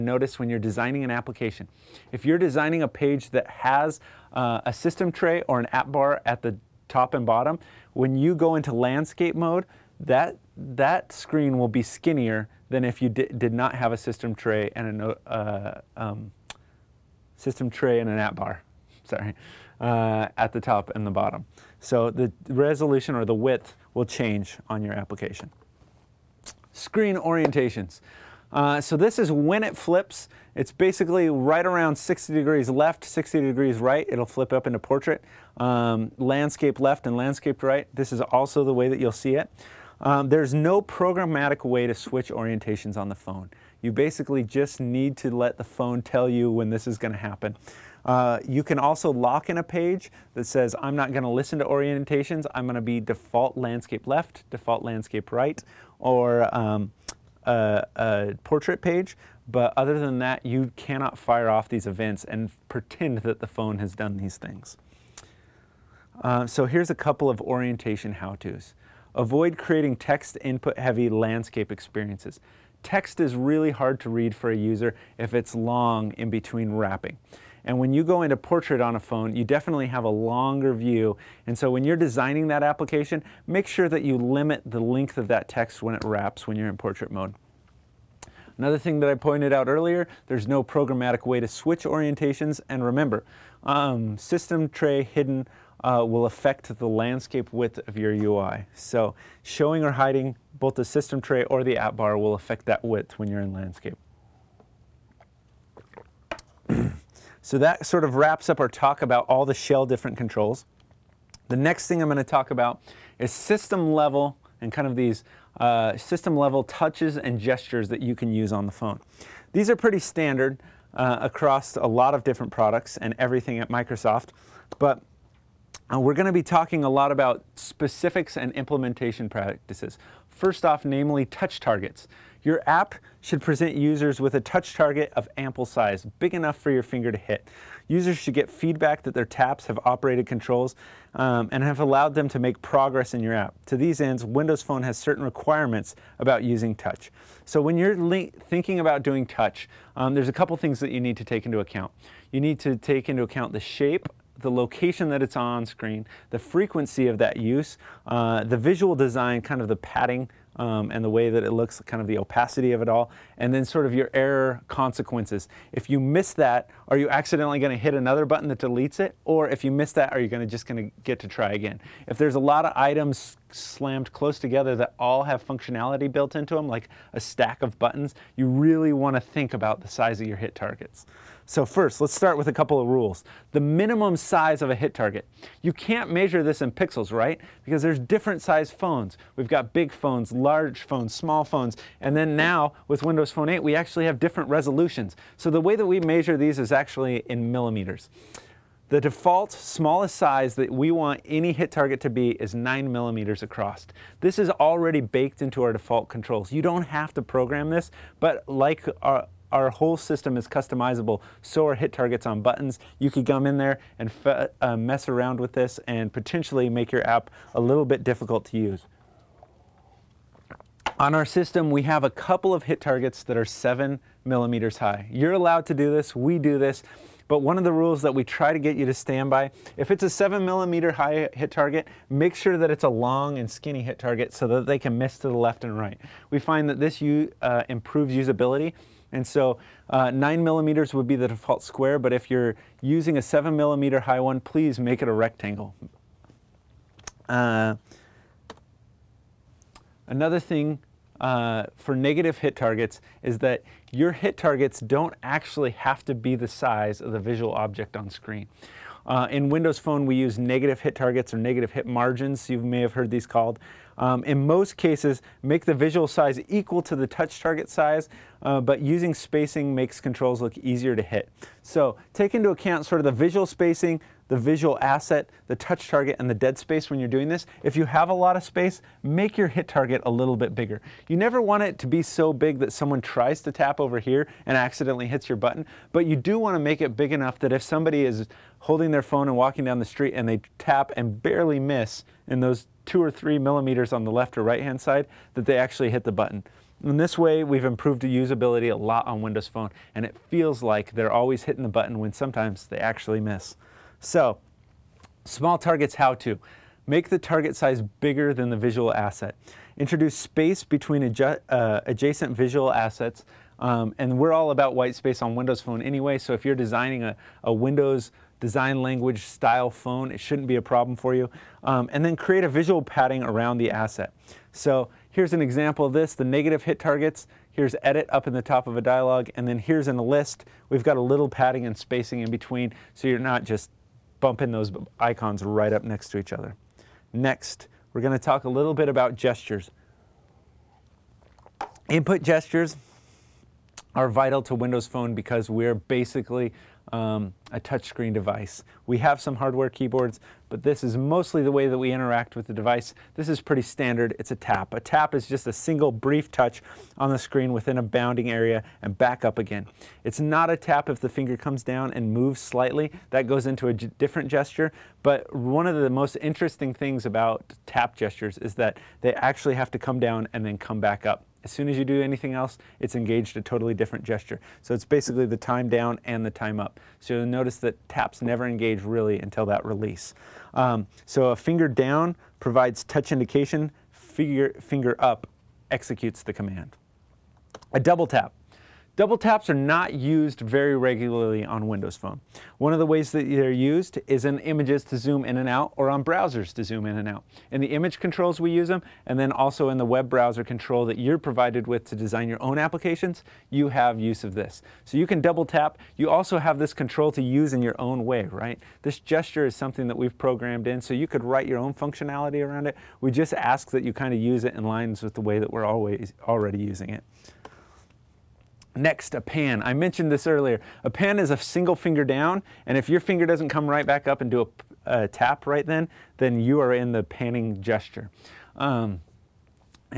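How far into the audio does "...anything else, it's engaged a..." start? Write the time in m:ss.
6:12.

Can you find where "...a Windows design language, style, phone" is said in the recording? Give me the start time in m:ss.
5:17.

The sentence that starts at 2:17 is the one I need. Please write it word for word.
Users should get feedback that their taps have operated controls um, and have allowed them to make progress in your app.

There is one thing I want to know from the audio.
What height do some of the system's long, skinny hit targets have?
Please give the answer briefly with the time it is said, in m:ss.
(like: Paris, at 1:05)
7 millimeters, at 3:43.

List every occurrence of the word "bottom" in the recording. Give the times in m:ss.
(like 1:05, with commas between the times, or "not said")
0:07, 0:21.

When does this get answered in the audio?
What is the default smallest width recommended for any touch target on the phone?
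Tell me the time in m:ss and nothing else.
3:22.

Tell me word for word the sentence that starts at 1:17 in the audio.
And when you go into portrait on a phone, you definitely have a longer view.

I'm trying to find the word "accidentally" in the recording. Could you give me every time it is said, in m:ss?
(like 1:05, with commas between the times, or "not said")
2:47, 4:44.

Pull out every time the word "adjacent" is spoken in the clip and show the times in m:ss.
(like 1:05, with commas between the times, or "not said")
5:11.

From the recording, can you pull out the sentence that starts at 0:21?
So the resolution or the width will change on your application.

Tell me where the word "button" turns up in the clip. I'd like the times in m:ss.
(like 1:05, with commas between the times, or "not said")
2:48, 2:57, 3:32, 4:45, 4:56, 5:01.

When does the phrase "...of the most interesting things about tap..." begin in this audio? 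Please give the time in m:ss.
6:05.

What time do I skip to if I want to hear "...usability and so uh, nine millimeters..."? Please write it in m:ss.
3:58.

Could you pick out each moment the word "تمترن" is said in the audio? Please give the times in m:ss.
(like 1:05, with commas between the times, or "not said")
not said.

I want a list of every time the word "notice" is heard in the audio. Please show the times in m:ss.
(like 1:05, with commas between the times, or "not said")
0:00, 6:17.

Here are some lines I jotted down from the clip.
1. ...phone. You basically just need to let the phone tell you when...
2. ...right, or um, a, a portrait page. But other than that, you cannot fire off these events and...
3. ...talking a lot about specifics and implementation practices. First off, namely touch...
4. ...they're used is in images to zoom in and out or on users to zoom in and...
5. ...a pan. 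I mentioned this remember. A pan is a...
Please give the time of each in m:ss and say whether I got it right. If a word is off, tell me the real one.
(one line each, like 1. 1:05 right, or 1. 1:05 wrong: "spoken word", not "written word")
1. 0:43 right
2. 0:55 right
3. 2:06 right
4. 6:33 wrong: "browsers", not "users"
5. 6:59 wrong: "earlier", not "remember".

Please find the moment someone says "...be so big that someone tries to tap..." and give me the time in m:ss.
4:41.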